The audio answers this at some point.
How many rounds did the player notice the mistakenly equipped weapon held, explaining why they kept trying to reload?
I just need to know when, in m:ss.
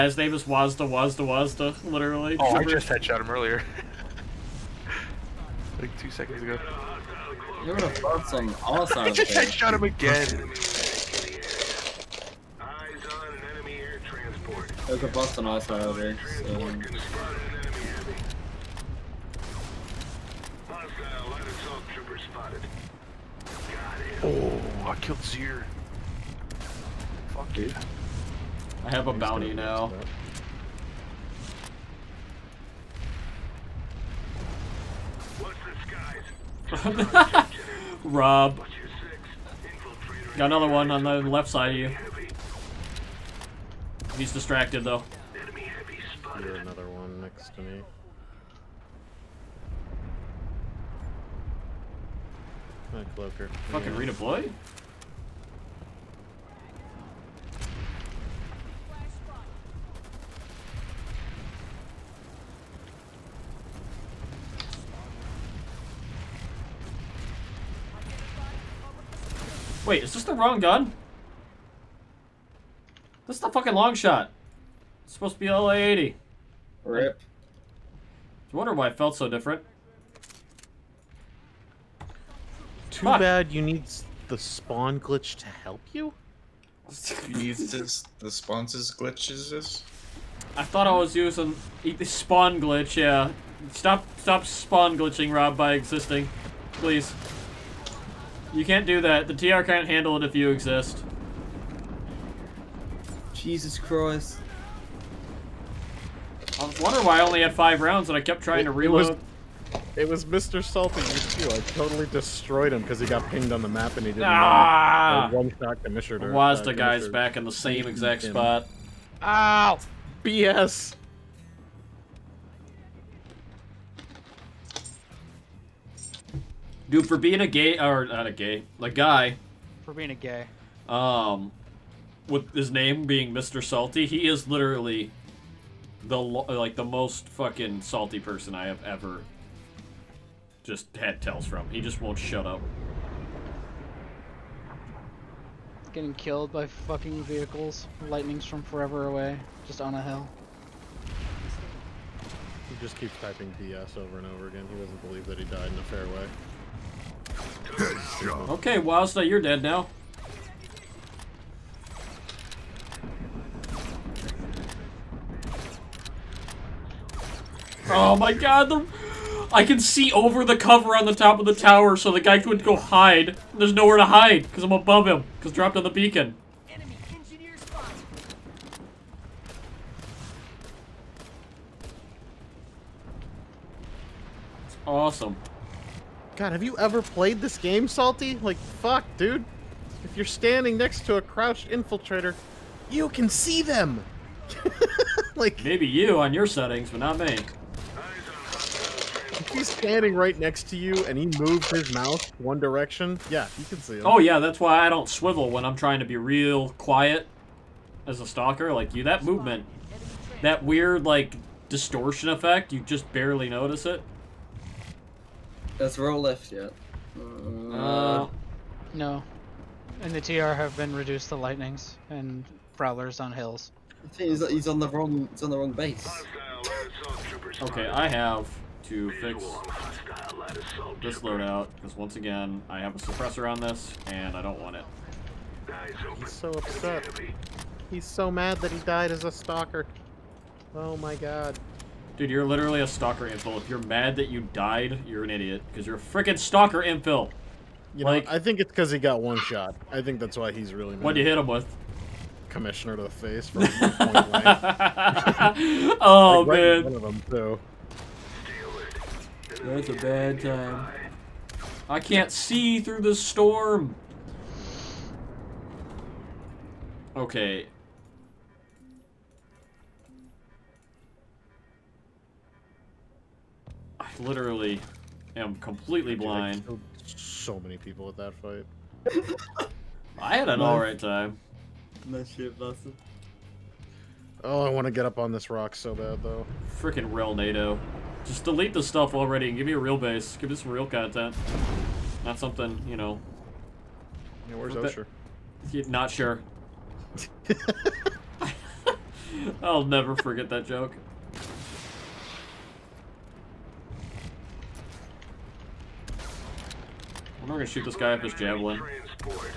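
1:47.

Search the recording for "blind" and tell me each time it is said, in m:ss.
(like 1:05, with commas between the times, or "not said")
4:36.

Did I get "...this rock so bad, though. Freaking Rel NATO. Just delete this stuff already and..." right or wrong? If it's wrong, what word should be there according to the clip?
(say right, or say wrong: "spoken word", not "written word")
right.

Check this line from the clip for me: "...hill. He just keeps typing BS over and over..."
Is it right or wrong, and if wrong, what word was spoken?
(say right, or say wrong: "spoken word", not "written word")
right.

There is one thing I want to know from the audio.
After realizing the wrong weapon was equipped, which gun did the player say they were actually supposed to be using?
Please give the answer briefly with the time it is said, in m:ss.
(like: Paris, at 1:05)
LA80, at 1:15.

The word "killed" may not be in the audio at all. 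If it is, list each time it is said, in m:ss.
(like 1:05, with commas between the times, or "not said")
0:24, 2:26.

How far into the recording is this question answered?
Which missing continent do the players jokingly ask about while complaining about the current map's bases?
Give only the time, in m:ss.
4:54.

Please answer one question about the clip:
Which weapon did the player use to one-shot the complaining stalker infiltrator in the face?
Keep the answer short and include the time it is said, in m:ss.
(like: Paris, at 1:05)
Commissioner, at 4:12.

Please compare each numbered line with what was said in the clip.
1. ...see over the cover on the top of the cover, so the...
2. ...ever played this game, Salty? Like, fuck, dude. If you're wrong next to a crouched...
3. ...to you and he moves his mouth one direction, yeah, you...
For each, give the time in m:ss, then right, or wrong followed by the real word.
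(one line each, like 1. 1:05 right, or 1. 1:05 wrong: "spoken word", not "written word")
1. 2:49 wrong: "tower", not "cover"
2. 3:06 wrong: "standing", not "wrong"
3. 3:20 right.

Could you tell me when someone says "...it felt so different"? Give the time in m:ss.
1:18.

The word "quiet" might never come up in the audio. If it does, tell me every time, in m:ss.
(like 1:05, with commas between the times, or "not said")
3:26.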